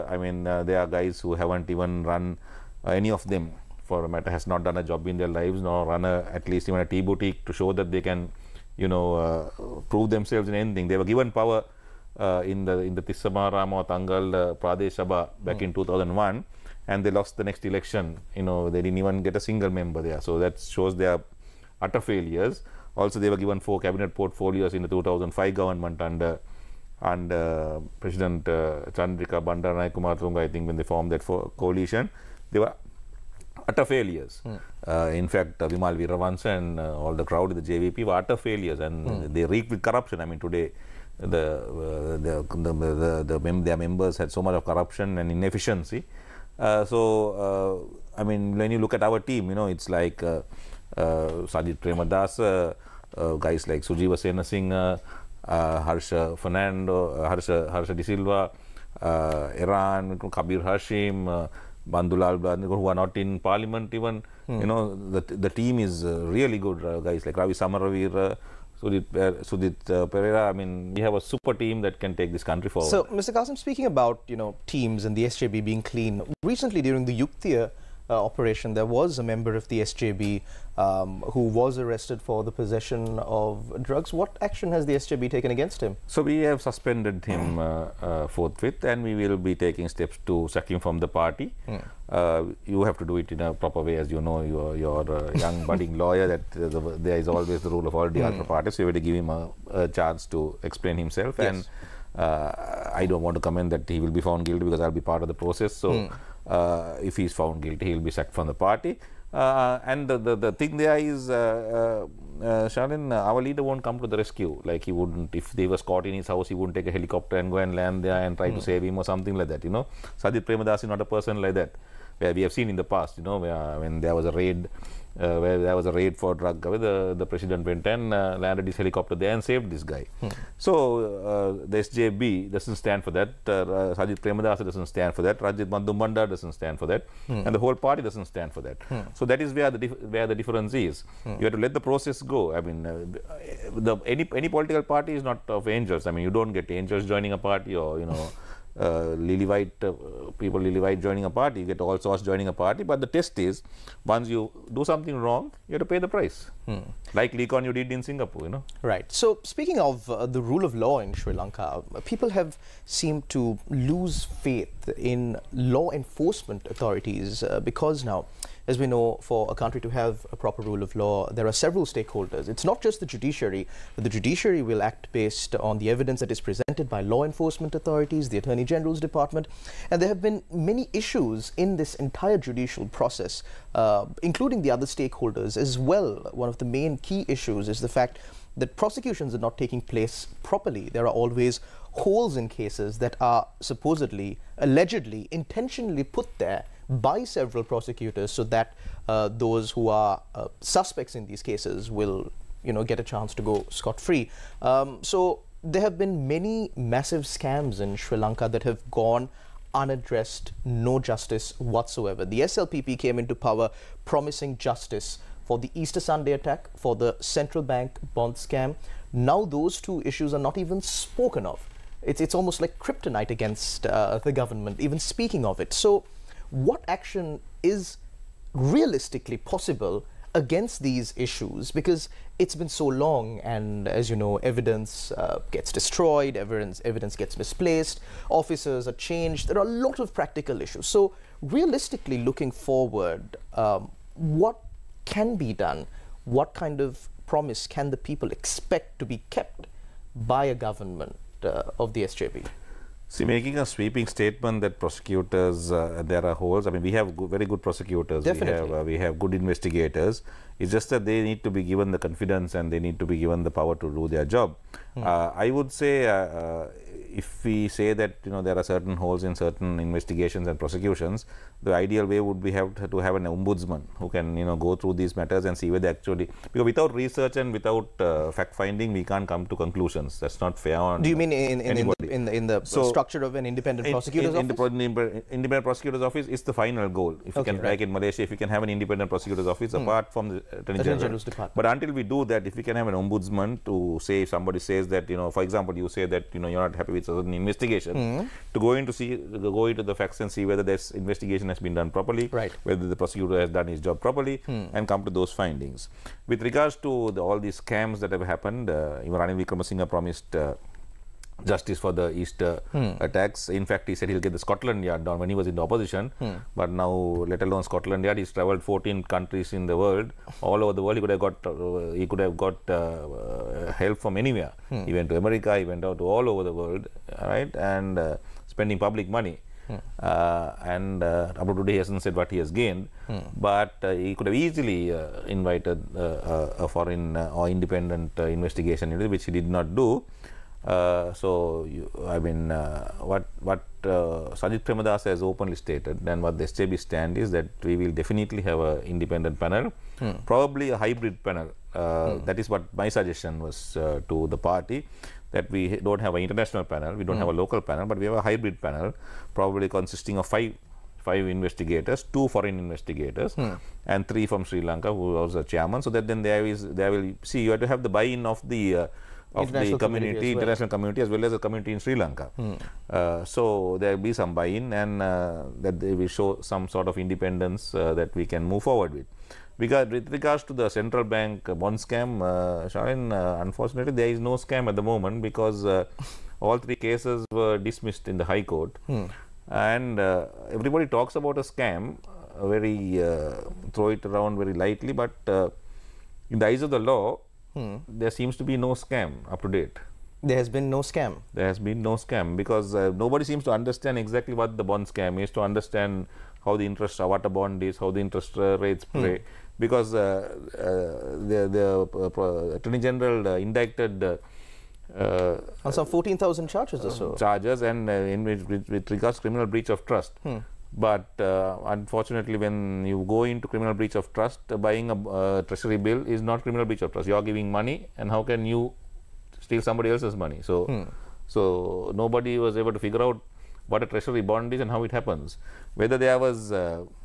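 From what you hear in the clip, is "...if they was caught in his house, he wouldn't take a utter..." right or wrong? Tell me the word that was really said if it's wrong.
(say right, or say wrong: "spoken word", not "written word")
wrong: "helicopter", not "utter".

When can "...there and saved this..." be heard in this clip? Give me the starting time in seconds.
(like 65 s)
129 s.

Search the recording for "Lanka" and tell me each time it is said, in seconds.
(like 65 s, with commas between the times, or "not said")
161 s, 208 s, 364 s, 371 s.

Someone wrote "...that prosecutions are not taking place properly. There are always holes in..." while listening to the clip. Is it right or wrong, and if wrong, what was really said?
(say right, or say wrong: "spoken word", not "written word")
right.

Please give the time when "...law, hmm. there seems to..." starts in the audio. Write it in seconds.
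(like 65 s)
396 s.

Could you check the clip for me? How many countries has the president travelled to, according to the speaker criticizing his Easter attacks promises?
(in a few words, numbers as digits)
14.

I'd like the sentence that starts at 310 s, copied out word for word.
Uh, justice for the Easter hmm.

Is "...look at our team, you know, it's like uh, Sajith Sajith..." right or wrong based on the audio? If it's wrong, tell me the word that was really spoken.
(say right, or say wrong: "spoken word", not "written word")
wrong: "Premadasa", not "Sajith".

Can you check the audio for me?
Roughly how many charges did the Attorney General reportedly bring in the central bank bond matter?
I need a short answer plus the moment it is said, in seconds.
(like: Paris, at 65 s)
14,000, at 415 s.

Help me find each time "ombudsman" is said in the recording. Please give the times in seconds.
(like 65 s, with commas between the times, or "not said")
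273 s, 292 s.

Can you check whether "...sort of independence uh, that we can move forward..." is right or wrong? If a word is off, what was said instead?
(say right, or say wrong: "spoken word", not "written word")
right.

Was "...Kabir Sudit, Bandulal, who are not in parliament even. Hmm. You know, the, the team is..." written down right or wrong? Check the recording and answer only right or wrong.
wrong.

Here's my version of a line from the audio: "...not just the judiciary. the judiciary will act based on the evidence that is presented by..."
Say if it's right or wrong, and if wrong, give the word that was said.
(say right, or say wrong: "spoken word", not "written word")
right.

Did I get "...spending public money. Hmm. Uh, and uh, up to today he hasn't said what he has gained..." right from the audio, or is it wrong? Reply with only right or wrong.
right.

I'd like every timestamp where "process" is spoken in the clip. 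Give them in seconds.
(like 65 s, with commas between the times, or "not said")
105 s, 141 s, 182 s.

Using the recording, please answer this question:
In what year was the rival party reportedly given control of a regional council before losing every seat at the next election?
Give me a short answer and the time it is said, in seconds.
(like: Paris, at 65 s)
2001, at 15 s.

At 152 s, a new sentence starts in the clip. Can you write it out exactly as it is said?
But the test is, once you do something wrong, you have to pay the price.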